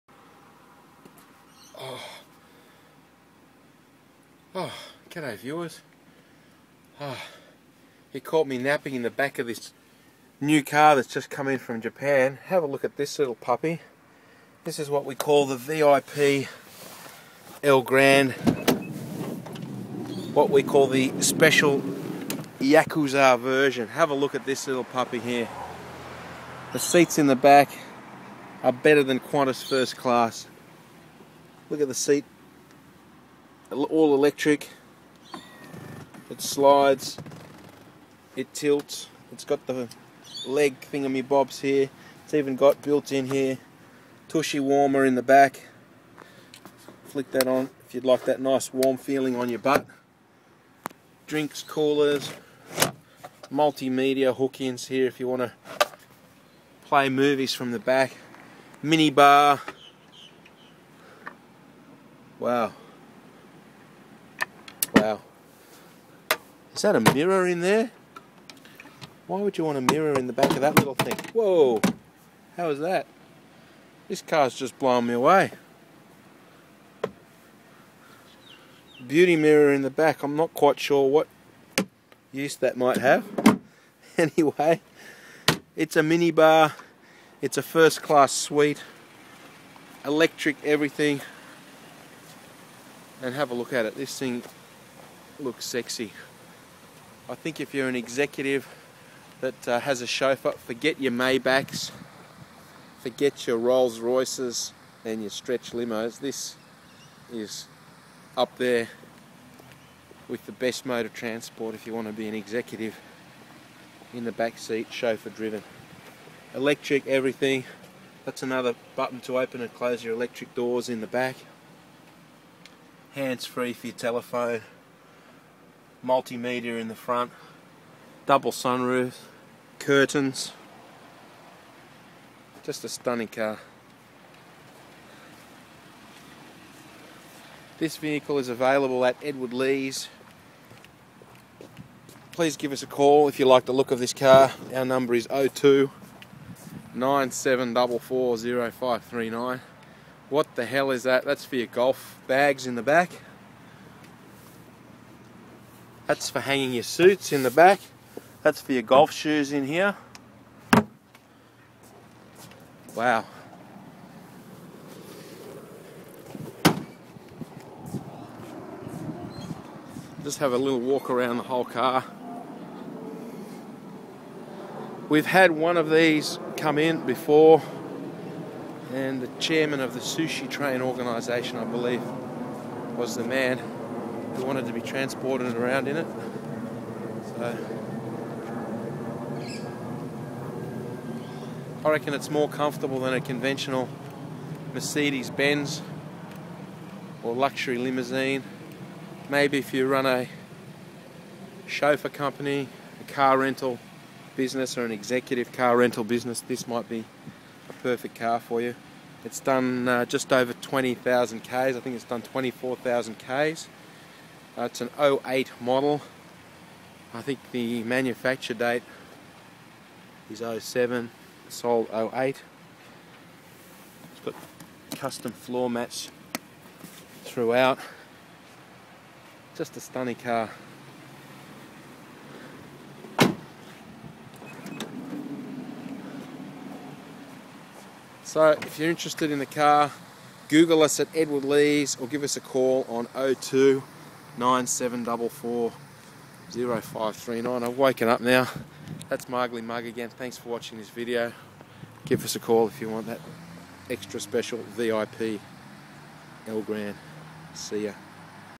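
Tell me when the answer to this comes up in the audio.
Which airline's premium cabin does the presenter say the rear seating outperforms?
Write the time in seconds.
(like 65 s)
29 s.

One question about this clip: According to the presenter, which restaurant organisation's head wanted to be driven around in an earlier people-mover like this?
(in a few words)
sushi train.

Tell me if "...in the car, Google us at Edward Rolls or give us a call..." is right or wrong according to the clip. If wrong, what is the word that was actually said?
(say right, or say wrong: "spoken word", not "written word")
wrong: "Lees", not "Rolls".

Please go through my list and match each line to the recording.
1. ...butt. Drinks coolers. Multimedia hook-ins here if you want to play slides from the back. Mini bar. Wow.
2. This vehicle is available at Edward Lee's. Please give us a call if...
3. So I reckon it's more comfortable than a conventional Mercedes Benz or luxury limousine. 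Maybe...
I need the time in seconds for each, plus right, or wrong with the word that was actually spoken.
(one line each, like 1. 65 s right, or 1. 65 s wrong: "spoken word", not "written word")
1. 49 s wrong: "movies", not "slides"
2. 137 s right
3. 187 s right.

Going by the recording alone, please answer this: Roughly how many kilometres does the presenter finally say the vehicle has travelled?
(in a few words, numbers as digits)
24,000.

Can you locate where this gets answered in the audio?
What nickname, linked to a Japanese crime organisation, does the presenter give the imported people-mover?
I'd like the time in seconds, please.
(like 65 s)
22 s.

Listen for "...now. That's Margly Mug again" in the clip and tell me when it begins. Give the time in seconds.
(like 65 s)
248 s.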